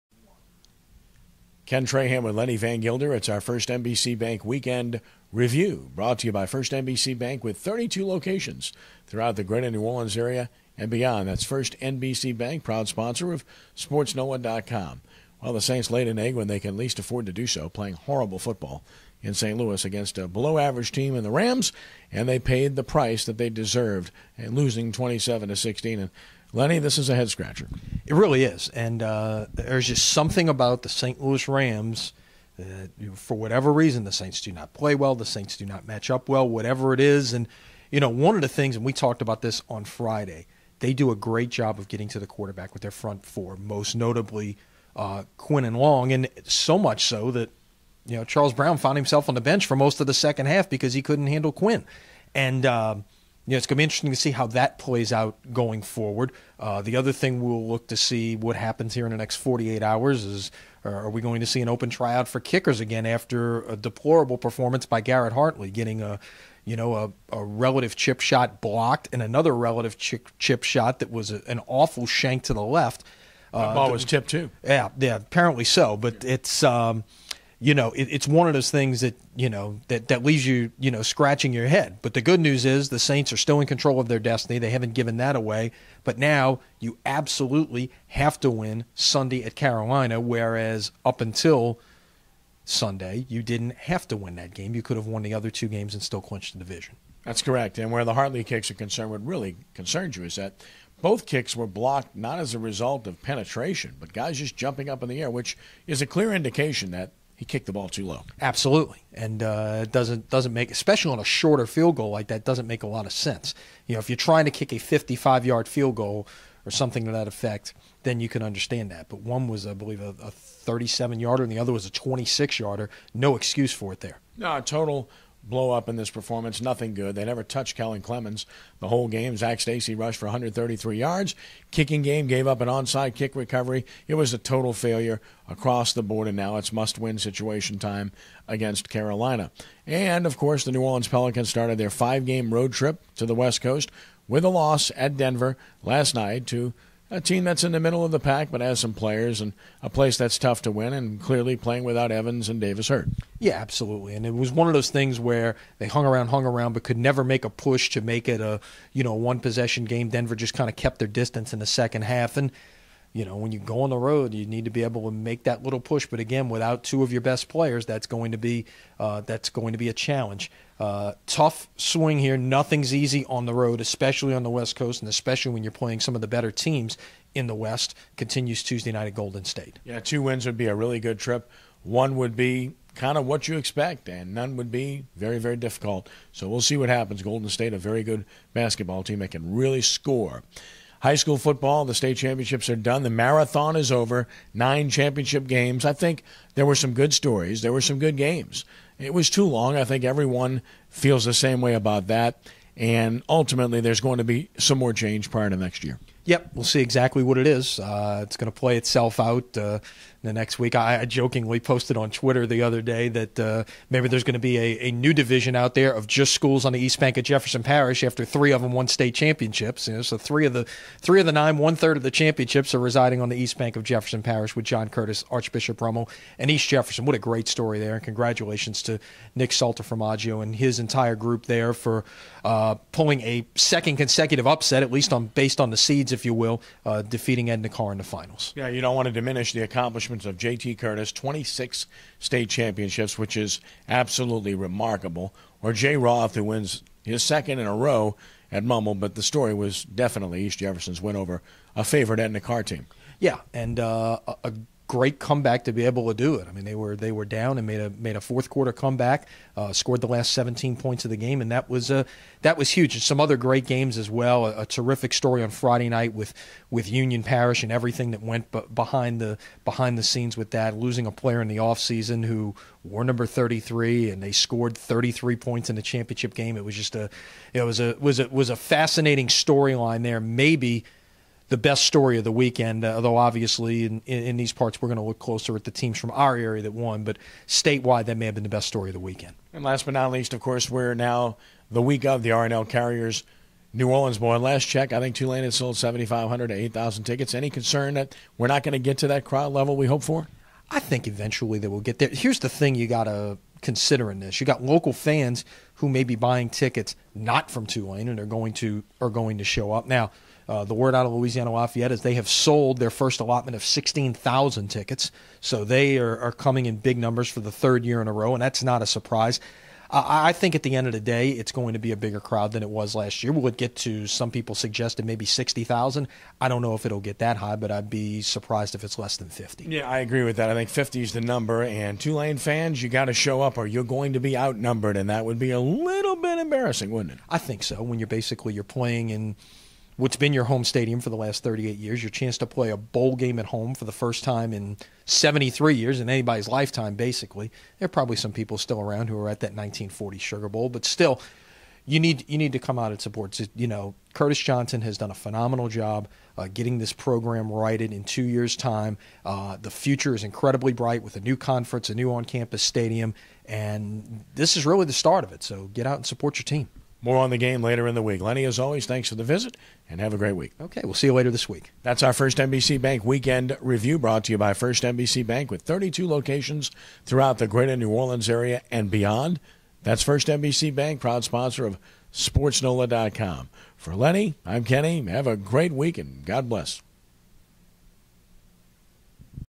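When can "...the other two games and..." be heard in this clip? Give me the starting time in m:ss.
1:35.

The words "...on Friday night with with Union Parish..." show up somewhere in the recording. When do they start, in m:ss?
4:25.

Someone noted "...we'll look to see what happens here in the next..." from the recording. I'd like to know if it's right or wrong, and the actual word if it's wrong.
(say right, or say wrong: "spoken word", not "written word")
right.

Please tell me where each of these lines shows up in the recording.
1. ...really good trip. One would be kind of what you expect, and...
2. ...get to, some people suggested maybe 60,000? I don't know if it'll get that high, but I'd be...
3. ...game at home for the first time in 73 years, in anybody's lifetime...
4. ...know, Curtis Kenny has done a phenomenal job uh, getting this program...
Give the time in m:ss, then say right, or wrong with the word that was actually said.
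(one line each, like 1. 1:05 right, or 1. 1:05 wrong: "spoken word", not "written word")
1. 3:00 right
2. 5:23 right
3. 5:43 right
4. 5:53 wrong: "Johnson", not "Kenny".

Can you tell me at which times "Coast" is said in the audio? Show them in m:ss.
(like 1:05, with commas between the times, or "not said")
2:23, 2:54.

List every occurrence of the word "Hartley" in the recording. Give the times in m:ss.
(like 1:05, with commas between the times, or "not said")
1:05, 1:38.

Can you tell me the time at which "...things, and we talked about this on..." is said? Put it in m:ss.
0:38.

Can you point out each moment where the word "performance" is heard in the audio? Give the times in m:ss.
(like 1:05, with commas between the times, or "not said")
1:04, 2:06.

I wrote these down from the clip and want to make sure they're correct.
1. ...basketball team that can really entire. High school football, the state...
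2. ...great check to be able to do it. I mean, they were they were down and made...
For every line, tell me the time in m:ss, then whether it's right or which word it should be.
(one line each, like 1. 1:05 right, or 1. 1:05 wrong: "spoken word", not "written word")
1. 3:08 wrong: "score", not "entire"
2. 4:14 wrong: "comeback", not "check".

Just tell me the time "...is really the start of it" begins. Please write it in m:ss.
6:04.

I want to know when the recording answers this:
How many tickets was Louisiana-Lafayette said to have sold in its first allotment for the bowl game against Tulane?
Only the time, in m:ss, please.
5:13.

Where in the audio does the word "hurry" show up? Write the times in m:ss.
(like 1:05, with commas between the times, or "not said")
not said.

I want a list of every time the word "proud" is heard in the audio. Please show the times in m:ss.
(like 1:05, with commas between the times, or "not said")
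0:12, 6:21.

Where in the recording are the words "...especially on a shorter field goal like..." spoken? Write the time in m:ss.
1:50.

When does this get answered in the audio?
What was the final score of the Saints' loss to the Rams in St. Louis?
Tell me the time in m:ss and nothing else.
0:24.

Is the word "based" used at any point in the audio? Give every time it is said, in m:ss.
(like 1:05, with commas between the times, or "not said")
3:55.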